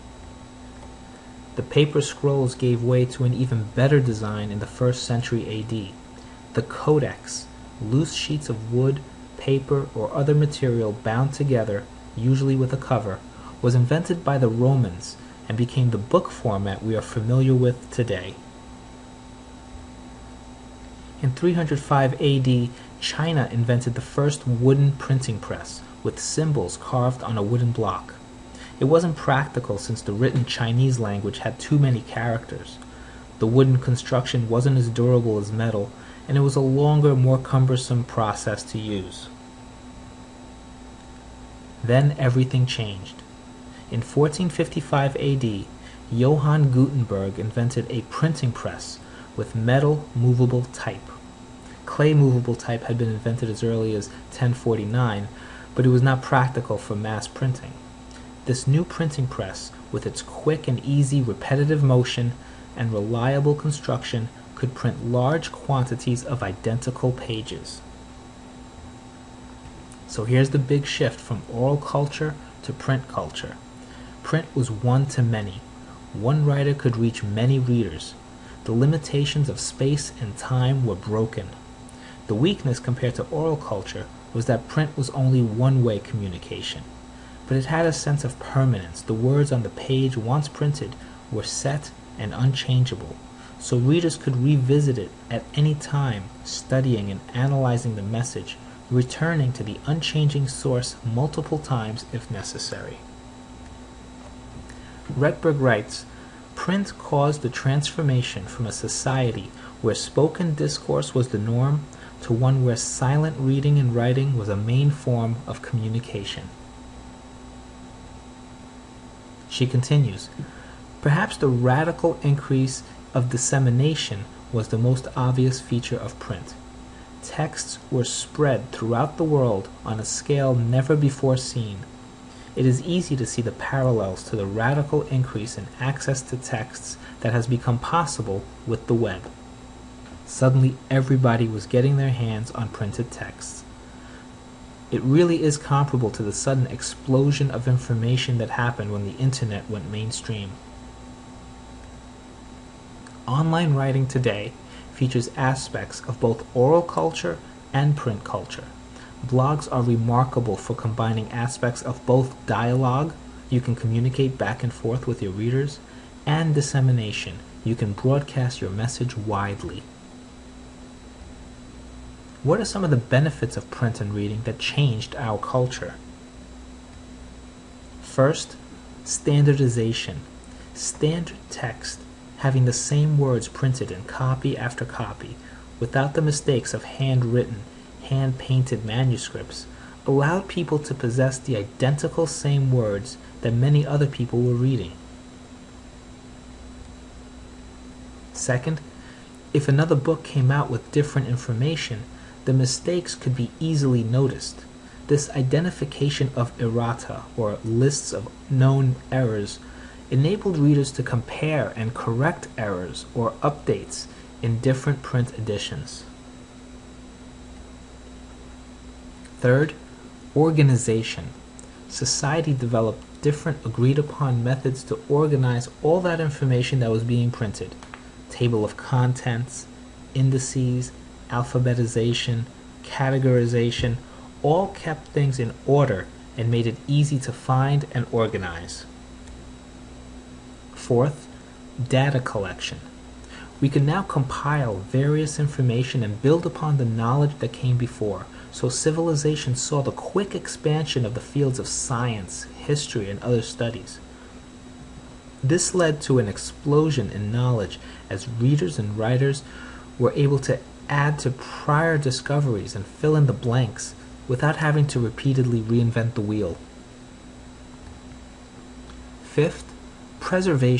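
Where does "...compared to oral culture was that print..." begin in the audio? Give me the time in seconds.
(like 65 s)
82 s.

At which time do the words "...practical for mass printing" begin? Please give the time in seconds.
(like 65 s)
56 s.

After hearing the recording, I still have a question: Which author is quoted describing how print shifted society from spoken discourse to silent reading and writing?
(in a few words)
Rettberg.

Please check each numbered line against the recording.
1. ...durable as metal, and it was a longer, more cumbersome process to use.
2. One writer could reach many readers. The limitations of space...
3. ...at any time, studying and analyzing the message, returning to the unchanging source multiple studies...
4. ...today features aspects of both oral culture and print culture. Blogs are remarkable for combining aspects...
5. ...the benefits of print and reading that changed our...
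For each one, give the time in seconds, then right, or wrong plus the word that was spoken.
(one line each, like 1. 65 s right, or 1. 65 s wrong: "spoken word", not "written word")
1. 34 s right
2. 76 s right
3. 95 s wrong: "times", not "studies"
4. 154 s right
5. 172 s right.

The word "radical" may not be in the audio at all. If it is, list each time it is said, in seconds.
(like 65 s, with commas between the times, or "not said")
121 s, 134 s.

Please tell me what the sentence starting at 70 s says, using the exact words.
So here's the big shift from oral culture to print culture.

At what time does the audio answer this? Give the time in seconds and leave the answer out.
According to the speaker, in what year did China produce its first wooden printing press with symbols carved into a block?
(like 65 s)
21 s.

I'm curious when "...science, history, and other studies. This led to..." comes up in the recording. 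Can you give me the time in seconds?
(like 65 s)
251 s.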